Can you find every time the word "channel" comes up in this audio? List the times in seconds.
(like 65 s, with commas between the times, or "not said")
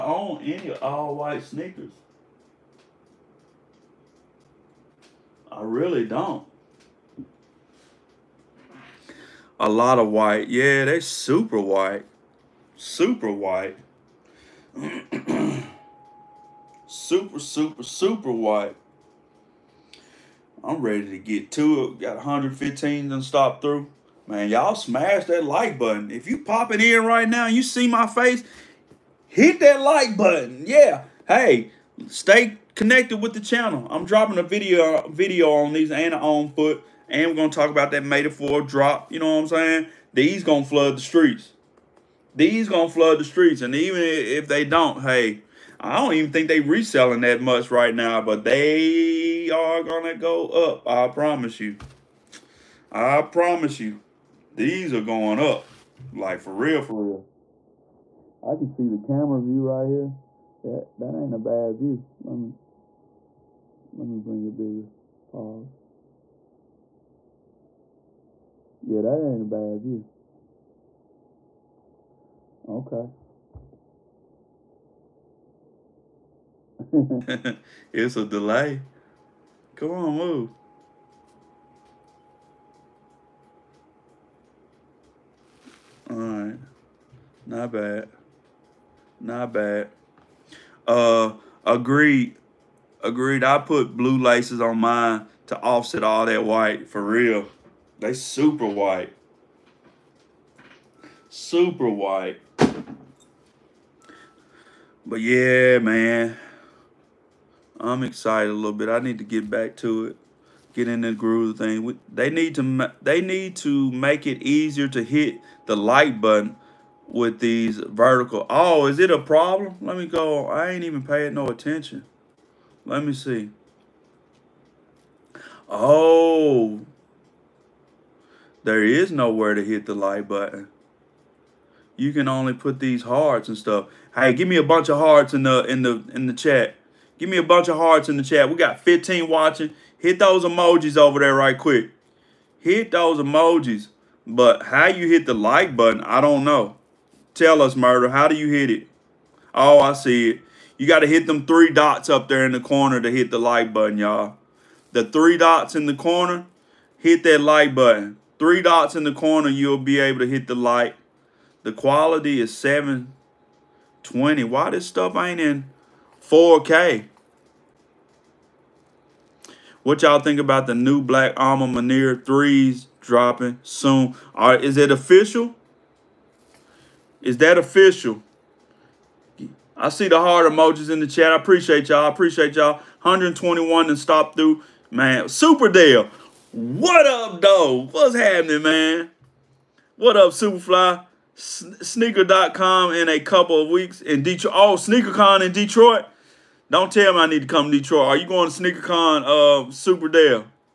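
33 s.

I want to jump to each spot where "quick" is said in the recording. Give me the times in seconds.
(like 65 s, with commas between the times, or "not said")
141 s.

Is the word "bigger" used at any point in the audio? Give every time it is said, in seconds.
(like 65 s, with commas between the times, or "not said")
64 s.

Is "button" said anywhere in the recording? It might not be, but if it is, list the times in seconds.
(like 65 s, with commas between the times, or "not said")
25 s, 30 s, 116 s, 130 s, 145 s, 153 s, 157 s.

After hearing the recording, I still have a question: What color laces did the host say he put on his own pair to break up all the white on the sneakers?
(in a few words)
Blue.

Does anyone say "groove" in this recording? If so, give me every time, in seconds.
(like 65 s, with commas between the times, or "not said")
111 s.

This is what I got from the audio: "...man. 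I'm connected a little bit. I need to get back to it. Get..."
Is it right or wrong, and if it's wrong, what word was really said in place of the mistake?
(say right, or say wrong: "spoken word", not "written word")
wrong: "excited", not "connected".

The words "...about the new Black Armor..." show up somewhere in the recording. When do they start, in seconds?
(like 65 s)
170 s.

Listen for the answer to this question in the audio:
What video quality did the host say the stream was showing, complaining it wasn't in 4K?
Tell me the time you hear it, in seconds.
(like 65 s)
162 s.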